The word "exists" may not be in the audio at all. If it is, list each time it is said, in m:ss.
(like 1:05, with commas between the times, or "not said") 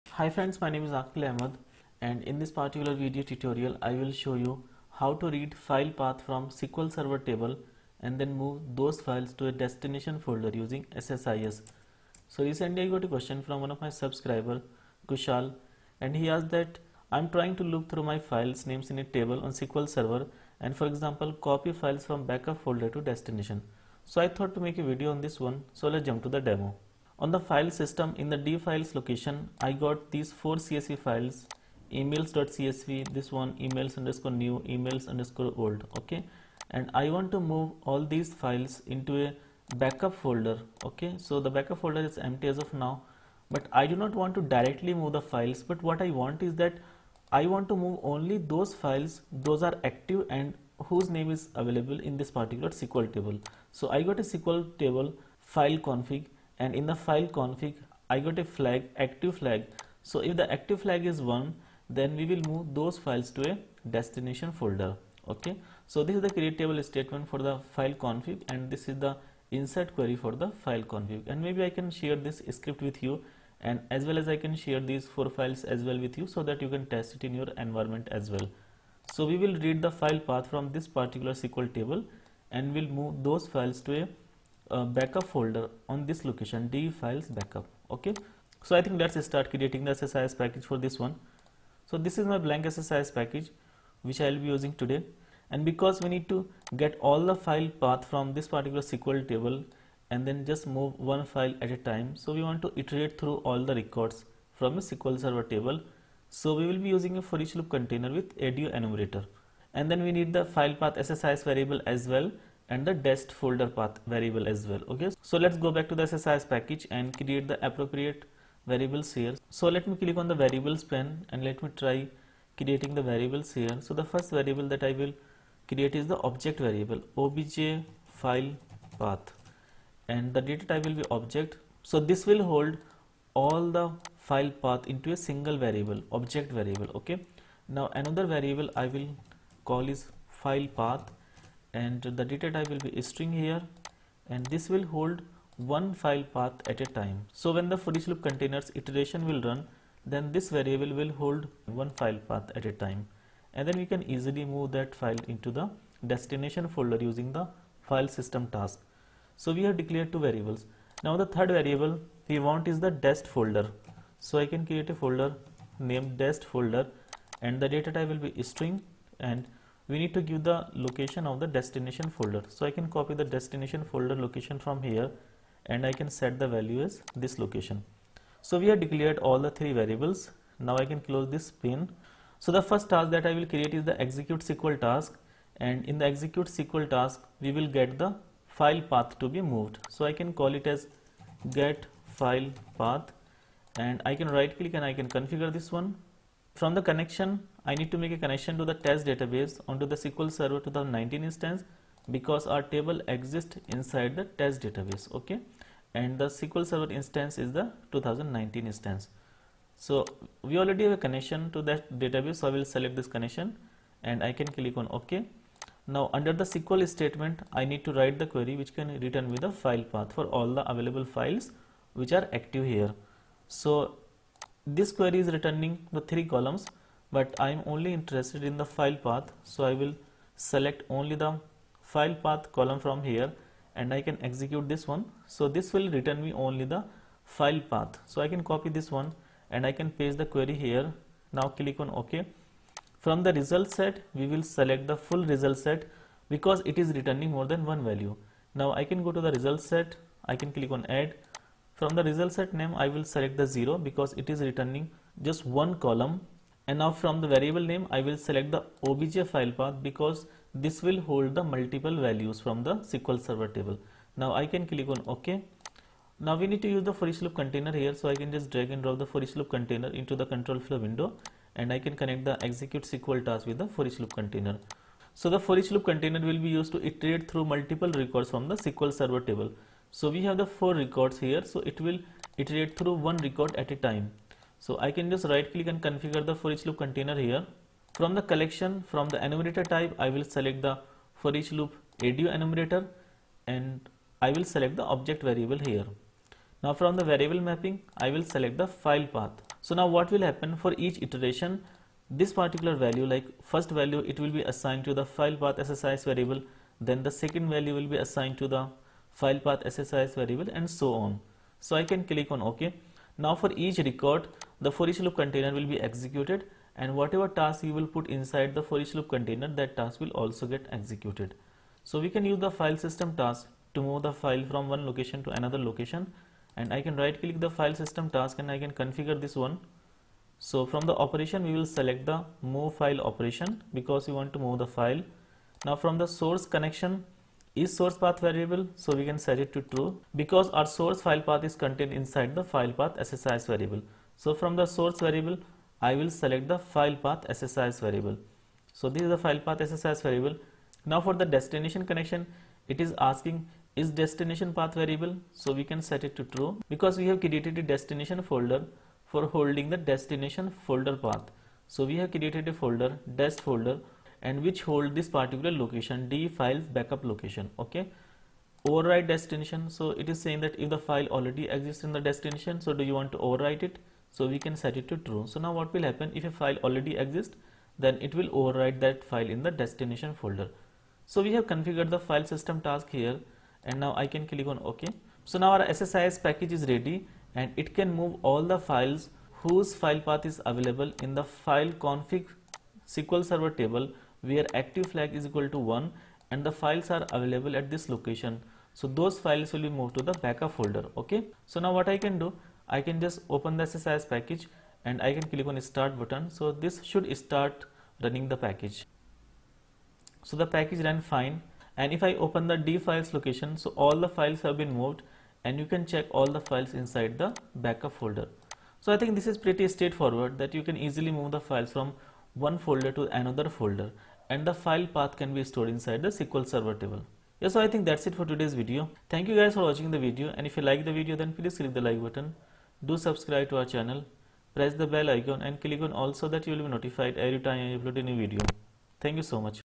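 3:23, 6:11, 6:17.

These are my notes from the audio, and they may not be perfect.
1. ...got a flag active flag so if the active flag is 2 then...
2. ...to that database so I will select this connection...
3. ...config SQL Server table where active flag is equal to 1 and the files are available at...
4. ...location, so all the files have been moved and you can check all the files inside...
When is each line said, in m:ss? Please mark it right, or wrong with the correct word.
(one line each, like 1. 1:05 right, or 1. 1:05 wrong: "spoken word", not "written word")
1. 0:58 wrong: "1", not "2"
2. 3:31 right
3. 6:31 right
4. 6:53 right.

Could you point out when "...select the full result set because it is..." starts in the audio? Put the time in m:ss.
4:04.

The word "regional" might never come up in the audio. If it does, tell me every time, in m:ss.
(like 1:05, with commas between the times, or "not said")
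not said.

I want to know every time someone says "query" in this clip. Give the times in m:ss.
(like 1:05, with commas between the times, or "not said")
1:09, 3:38, 3:44, 4:00.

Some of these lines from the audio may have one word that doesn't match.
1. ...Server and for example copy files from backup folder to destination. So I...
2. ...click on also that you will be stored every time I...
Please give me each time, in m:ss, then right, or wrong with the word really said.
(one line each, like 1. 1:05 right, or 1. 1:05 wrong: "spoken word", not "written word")
1. 0:19 right
2. 7:15 wrong: "notified", not "stored".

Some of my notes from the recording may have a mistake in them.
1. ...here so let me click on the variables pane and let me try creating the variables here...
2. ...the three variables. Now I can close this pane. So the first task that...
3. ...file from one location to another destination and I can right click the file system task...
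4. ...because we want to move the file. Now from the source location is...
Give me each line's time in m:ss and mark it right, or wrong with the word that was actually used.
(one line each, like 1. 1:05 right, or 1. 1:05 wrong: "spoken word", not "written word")
1. 1:59 right
2. 2:59 right
3. 5:24 wrong: "location", not "destination"
4. 5:33 wrong: "connection", not "location".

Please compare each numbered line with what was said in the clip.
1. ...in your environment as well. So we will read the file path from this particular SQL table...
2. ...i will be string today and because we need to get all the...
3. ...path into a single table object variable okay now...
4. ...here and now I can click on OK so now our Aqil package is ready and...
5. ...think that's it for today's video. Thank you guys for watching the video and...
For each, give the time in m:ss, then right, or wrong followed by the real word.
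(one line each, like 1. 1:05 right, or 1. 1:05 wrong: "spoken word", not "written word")
1. 1:17 right
2. 1:34 wrong: "using", not "string"
3. 2:14 wrong: "variable", not "table"
4. 6:22 wrong: "SSIS", not "Aqil"
5. 7:07 right.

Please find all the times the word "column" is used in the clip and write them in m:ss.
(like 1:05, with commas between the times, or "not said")
3:46, 3:52, 4:15.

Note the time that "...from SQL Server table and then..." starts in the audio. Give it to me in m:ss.
0:06.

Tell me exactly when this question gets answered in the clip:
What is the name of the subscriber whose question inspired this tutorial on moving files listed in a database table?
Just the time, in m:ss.
0:15.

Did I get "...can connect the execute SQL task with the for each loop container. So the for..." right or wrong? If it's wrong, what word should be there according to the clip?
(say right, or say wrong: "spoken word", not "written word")
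right.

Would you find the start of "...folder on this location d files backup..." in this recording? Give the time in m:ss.
1:25.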